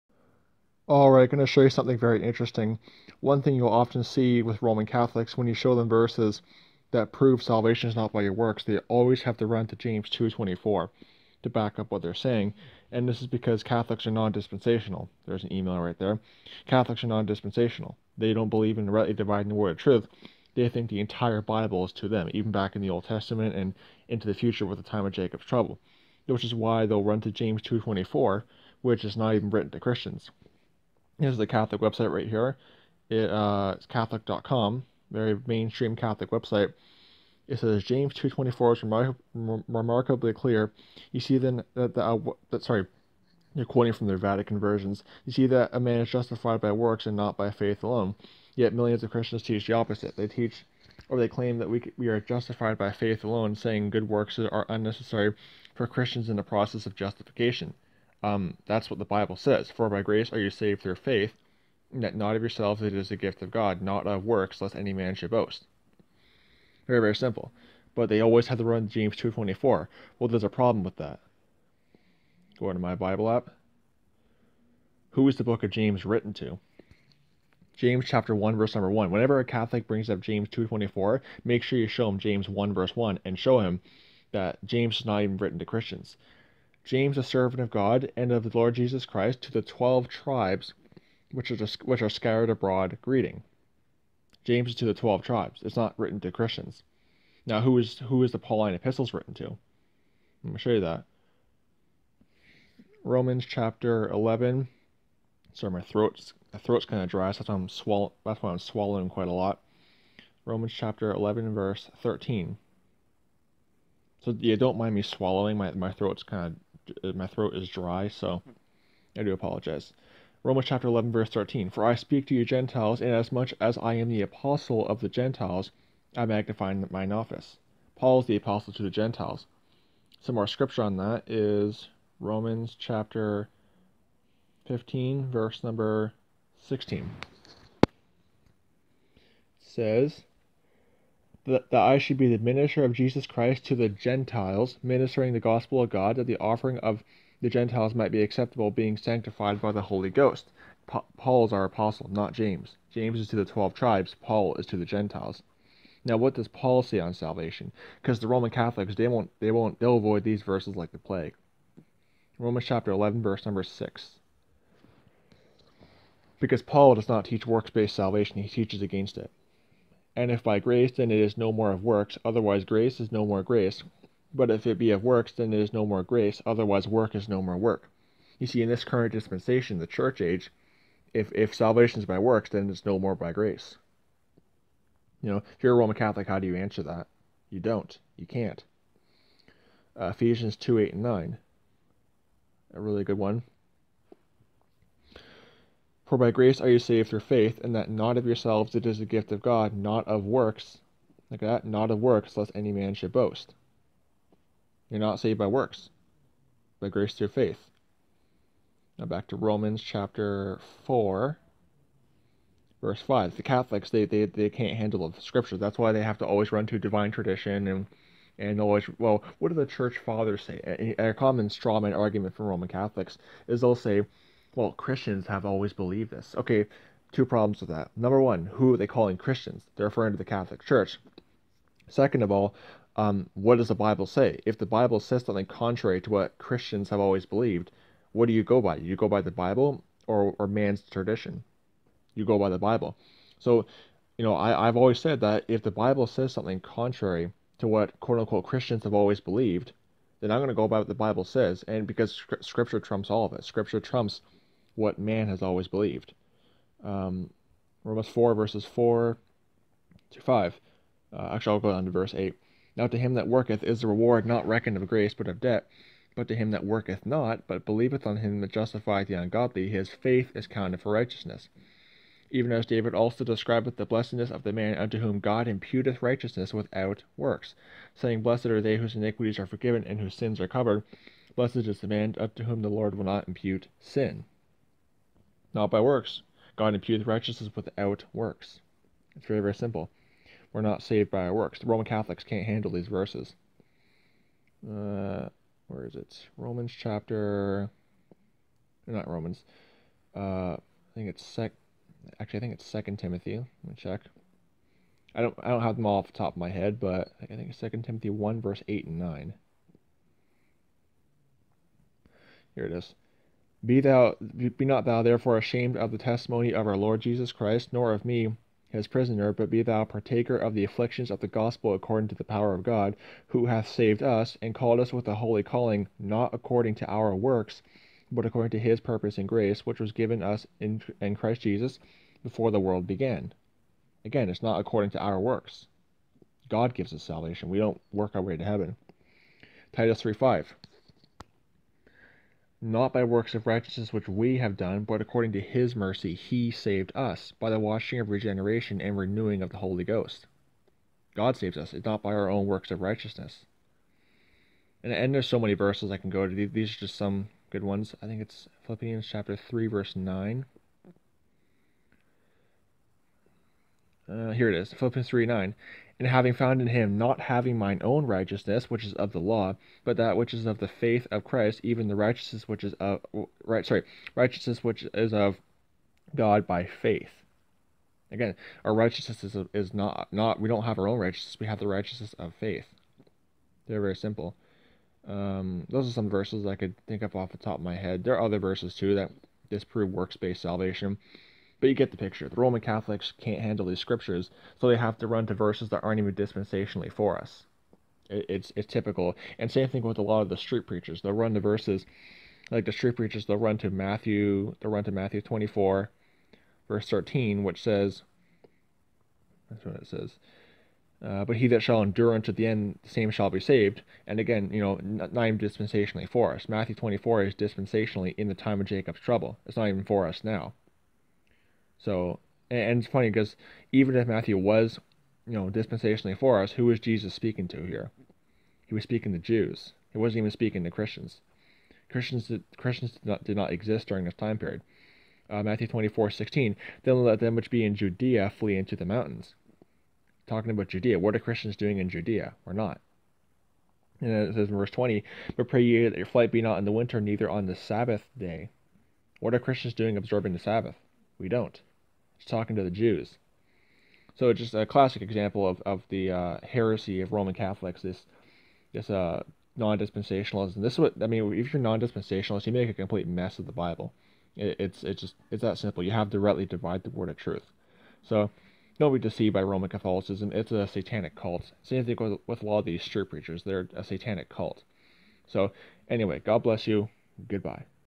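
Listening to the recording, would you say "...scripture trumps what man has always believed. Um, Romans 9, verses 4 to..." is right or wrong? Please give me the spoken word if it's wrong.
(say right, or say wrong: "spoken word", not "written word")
wrong: "4", not "9".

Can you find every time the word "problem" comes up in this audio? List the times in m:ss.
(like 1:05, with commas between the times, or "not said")
1:10, 3:47.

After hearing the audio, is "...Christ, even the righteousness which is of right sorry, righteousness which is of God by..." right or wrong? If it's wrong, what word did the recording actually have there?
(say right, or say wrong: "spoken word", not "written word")
right.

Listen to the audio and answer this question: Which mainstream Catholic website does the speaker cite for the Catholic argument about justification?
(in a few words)
Catholic.com.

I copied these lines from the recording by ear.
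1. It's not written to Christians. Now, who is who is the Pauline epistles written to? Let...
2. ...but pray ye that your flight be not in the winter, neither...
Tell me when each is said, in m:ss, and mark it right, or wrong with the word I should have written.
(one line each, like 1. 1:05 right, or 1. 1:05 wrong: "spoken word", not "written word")
1. 1:35 right
2. 7:25 right.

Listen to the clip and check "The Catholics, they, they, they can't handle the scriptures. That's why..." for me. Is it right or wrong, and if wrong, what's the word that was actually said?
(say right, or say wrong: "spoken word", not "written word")
right.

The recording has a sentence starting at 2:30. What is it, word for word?
Pa- Paul is our apostle, not James.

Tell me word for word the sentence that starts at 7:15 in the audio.
Uh, Matthew 24, 16, then let them which be in Judea flee into the mountains.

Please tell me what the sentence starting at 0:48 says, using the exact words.
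Yet millions of Christians teach the opposite.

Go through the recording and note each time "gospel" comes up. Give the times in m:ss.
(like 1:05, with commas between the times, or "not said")
2:25, 5:21.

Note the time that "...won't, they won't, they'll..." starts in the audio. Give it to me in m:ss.
2:39.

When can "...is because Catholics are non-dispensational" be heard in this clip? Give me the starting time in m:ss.
0:13.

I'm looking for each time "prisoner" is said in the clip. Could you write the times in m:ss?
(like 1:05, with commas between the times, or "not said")
5:18.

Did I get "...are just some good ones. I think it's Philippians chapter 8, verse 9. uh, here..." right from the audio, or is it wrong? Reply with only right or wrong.
wrong.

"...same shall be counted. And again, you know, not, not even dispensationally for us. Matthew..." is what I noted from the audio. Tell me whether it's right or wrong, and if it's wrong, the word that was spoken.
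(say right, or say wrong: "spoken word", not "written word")
wrong: "saved", not "counted".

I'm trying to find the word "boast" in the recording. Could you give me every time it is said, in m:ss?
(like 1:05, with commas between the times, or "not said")
1:05, 3:23.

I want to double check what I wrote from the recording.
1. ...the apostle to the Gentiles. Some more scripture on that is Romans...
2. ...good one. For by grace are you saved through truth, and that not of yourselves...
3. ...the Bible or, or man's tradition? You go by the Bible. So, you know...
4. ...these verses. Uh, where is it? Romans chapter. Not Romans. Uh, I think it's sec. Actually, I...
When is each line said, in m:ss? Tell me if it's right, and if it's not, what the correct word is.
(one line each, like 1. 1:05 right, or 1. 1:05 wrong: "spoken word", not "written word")
1. 2:08 right
2. 3:13 wrong: "faith", not "truth"
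3. 3:59 right
4. 4:52 right.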